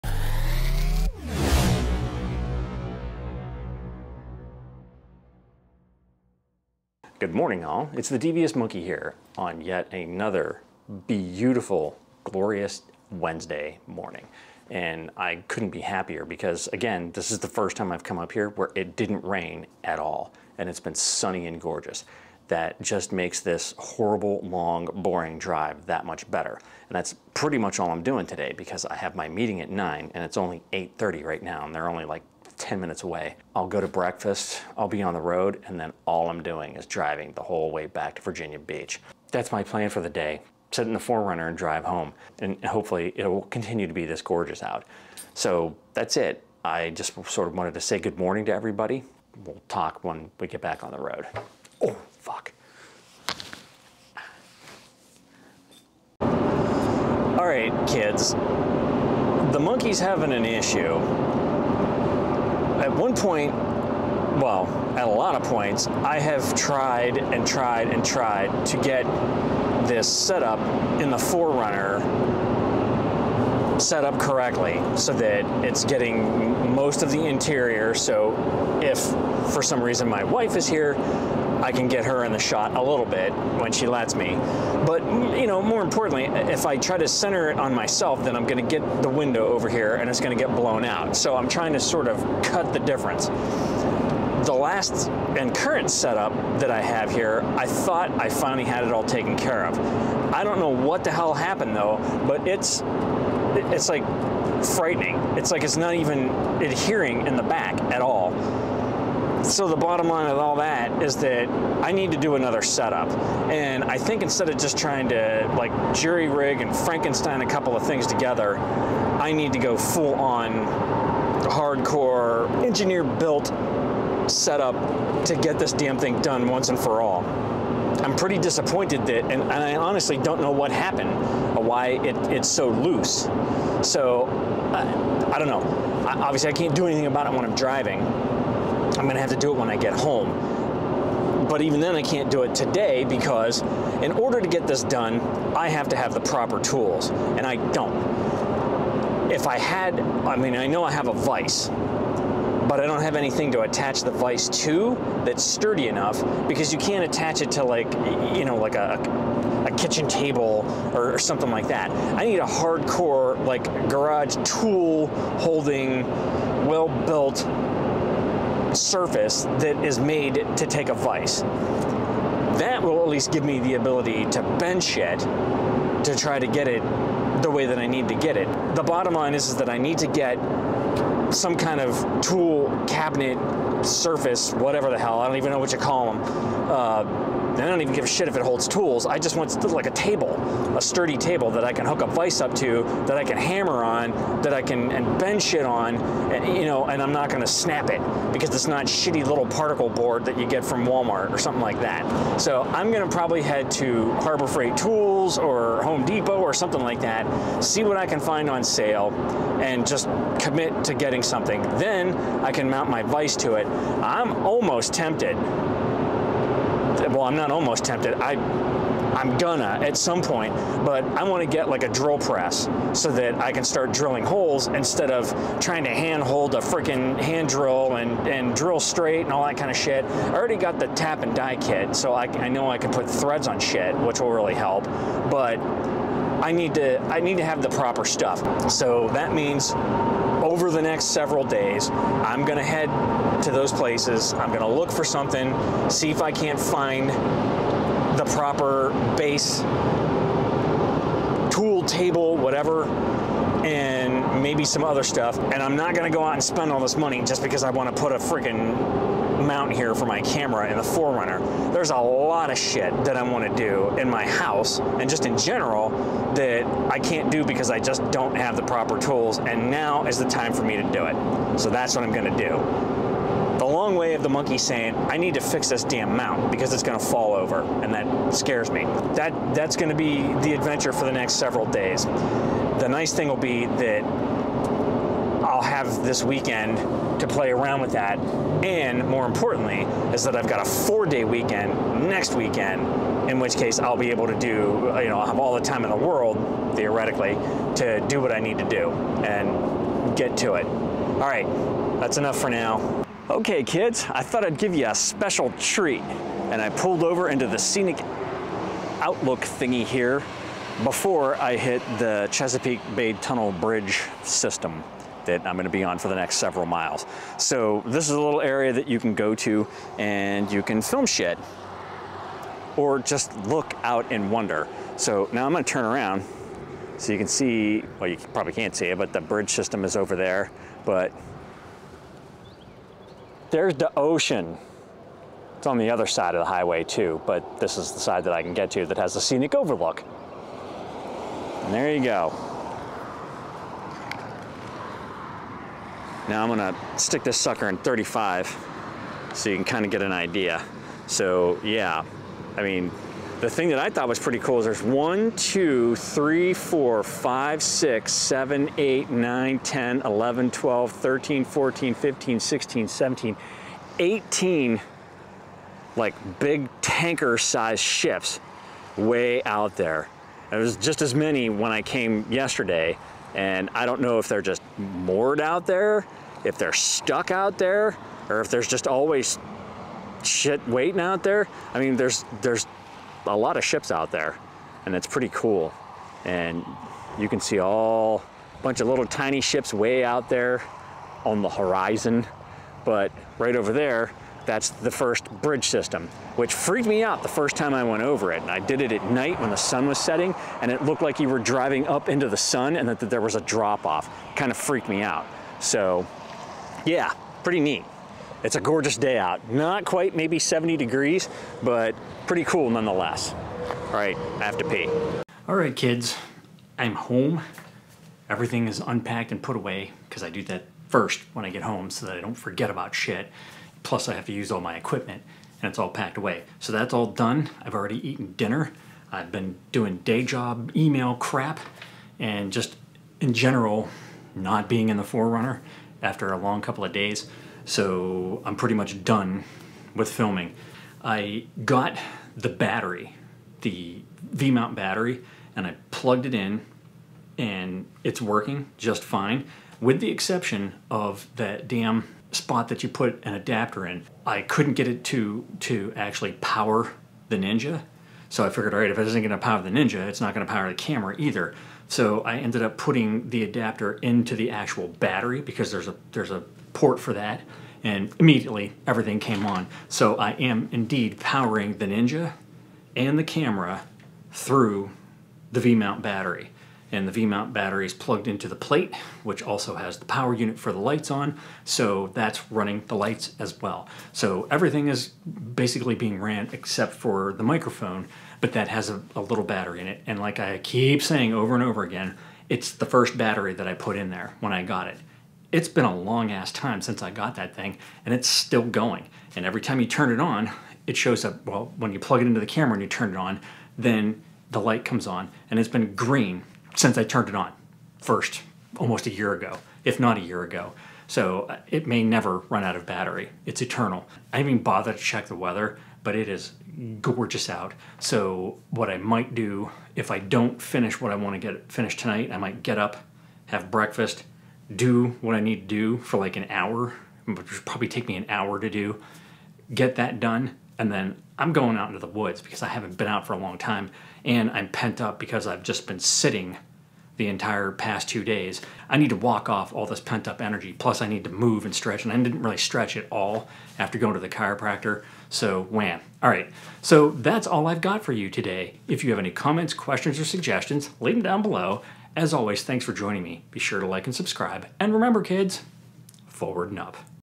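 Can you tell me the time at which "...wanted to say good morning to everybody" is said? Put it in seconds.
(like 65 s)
47 s.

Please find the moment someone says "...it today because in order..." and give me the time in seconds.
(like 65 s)
142 s.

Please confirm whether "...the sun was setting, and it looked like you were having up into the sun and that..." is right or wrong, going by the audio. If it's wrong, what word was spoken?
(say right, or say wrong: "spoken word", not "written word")
wrong: "driving", not "having".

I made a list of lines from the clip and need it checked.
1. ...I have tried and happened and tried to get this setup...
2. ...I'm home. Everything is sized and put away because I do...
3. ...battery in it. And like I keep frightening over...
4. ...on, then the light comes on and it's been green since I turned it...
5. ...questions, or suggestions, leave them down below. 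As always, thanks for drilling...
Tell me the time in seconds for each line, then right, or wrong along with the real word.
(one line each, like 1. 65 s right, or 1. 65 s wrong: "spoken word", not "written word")
1. 65 s wrong: "tried", not "happened"
2. 416 s wrong: "unpacked", not "sized"
3. 489 s wrong: "saying", not "frightening"
4. 503 s right
5. 549 s wrong: "joining", not "drilling".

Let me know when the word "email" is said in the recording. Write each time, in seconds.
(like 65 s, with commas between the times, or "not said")
430 s.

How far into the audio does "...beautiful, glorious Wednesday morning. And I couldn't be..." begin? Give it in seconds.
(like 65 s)
11 s.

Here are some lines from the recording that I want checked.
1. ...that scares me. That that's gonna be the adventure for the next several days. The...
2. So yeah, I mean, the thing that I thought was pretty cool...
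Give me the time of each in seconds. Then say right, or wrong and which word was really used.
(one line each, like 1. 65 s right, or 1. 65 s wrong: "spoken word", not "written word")
1. 277 s right
2. 351 s right.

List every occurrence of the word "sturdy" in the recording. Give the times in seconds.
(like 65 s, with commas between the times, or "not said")
155 s, 190 s.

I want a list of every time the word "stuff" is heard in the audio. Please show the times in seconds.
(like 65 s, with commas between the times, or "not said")
238 s, 255 s.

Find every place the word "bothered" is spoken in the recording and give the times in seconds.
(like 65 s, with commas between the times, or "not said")
514 s.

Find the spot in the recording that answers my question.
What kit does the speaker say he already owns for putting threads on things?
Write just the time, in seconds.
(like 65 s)
230 s.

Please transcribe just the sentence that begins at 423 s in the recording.
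Plus, I have to use all my equipment and it's all packed away.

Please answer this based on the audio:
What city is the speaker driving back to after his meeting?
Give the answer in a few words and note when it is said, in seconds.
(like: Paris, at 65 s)
Virginia Beach, at 38 s.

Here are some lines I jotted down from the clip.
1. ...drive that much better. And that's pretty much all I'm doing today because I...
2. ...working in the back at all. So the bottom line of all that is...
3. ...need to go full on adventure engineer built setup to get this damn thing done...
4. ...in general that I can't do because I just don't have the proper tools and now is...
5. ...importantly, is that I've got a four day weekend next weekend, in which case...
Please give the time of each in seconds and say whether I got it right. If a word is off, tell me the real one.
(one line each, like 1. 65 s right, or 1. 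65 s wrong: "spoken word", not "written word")
1. 25 s right
2. 106 s wrong: "adhering", not "working"
3. 119 s wrong: "hardcore", not "adventure"
4. 265 s right
5. 289 s right.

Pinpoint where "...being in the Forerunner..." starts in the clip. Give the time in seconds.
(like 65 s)
434 s.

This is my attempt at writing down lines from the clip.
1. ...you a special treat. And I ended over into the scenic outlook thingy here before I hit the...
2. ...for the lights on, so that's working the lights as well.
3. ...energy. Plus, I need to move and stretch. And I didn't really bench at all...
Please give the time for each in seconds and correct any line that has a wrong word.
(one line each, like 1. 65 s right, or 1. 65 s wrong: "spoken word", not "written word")
1. 304 s wrong: "pulled", not "ended"
2. 480 s wrong: "running", not "working"
3. 540 s wrong: "stretch", not "bench".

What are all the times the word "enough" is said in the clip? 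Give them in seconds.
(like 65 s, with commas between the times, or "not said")
155 s, 302 s.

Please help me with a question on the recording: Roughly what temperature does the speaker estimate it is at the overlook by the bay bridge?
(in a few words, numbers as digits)
70 degrees.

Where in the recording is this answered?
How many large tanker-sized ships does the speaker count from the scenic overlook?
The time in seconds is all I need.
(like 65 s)
363 s.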